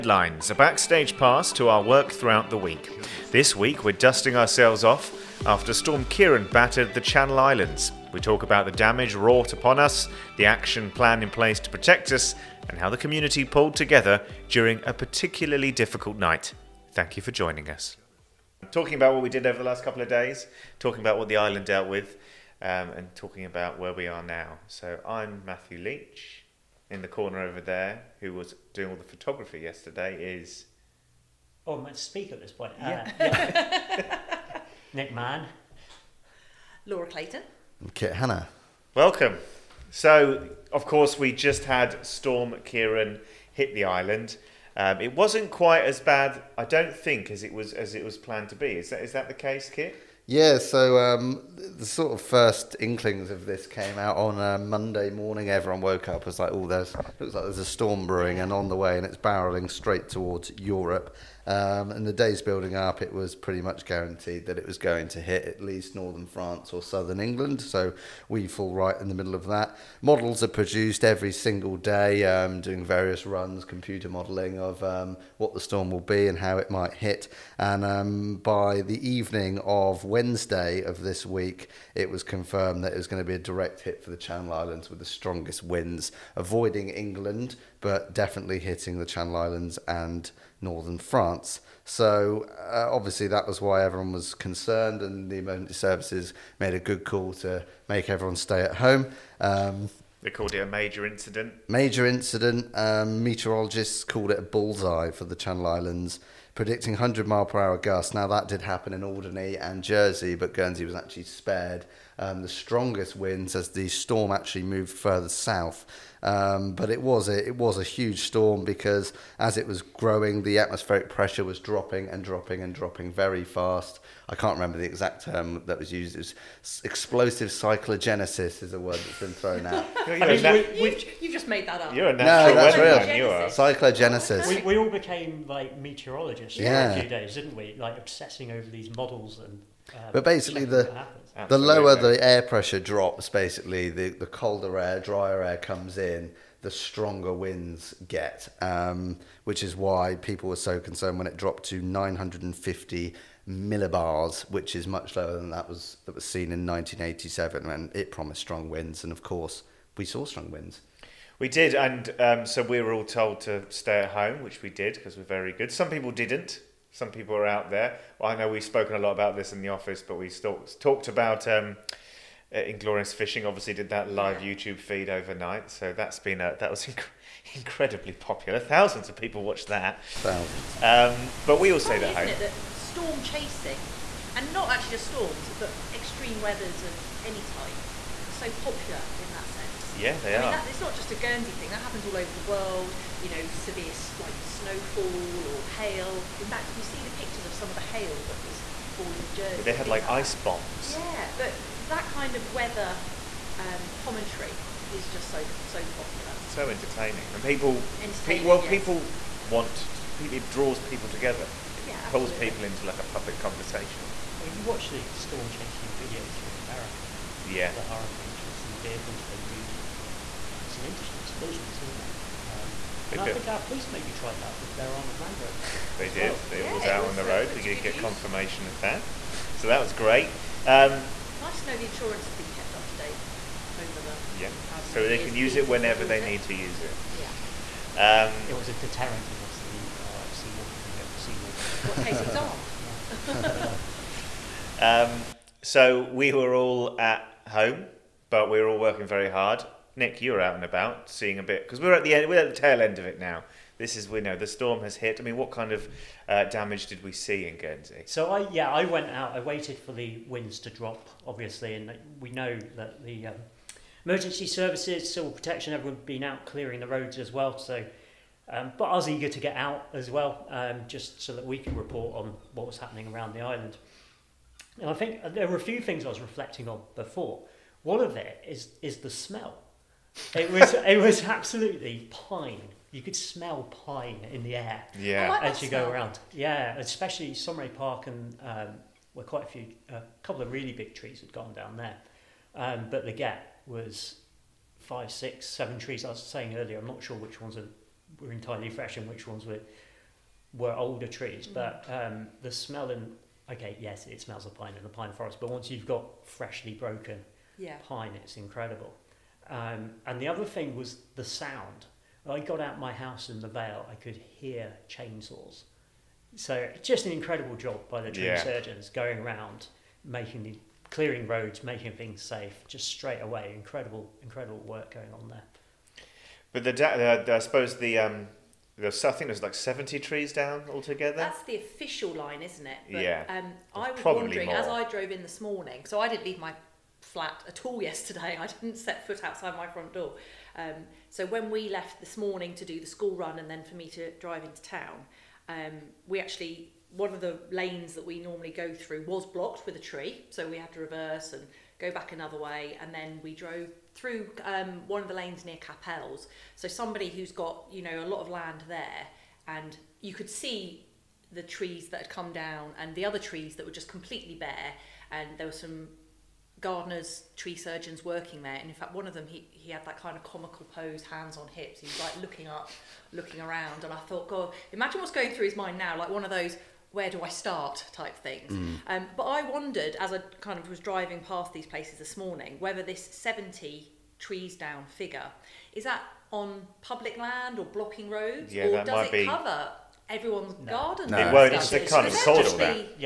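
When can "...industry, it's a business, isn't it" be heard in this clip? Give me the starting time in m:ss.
3:40.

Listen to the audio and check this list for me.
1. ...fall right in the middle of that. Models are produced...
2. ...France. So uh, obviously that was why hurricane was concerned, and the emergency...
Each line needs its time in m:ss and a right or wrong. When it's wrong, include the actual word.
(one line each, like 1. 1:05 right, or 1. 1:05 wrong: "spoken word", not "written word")
1. 1:08 right
2. 1:30 wrong: "everyone", not "hurricane".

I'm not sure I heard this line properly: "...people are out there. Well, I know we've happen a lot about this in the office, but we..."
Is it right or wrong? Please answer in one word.
wrong.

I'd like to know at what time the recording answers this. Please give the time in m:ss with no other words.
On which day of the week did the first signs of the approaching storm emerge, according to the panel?
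0:54.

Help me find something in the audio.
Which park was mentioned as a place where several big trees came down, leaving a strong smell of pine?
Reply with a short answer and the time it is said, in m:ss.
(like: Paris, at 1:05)
Saumarez Park, at 4:47.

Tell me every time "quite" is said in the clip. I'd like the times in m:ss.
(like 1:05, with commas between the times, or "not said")
0:45, 4:49.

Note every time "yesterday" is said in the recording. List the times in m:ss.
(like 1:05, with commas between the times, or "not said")
0:29, 5:37.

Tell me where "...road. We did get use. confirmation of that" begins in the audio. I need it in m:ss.
3:47.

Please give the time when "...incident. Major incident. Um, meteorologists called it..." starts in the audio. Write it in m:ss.
1:41.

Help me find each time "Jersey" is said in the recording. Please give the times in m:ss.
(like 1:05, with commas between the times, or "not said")
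1:49, 3:19.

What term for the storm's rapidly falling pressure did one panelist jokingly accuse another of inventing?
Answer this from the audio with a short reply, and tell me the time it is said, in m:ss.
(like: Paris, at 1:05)
explosive cyclogenesis, at 2:06.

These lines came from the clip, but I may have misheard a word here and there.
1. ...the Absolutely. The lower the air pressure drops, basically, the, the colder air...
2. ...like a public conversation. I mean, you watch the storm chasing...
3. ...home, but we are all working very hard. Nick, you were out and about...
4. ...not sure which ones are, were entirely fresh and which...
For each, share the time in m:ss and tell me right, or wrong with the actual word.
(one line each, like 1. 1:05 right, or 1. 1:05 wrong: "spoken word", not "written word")
1. 2:20 right
2. 3:32 right
3. 4:07 right
4. 4:56 right.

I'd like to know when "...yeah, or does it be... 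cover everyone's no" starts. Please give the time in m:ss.
6:28.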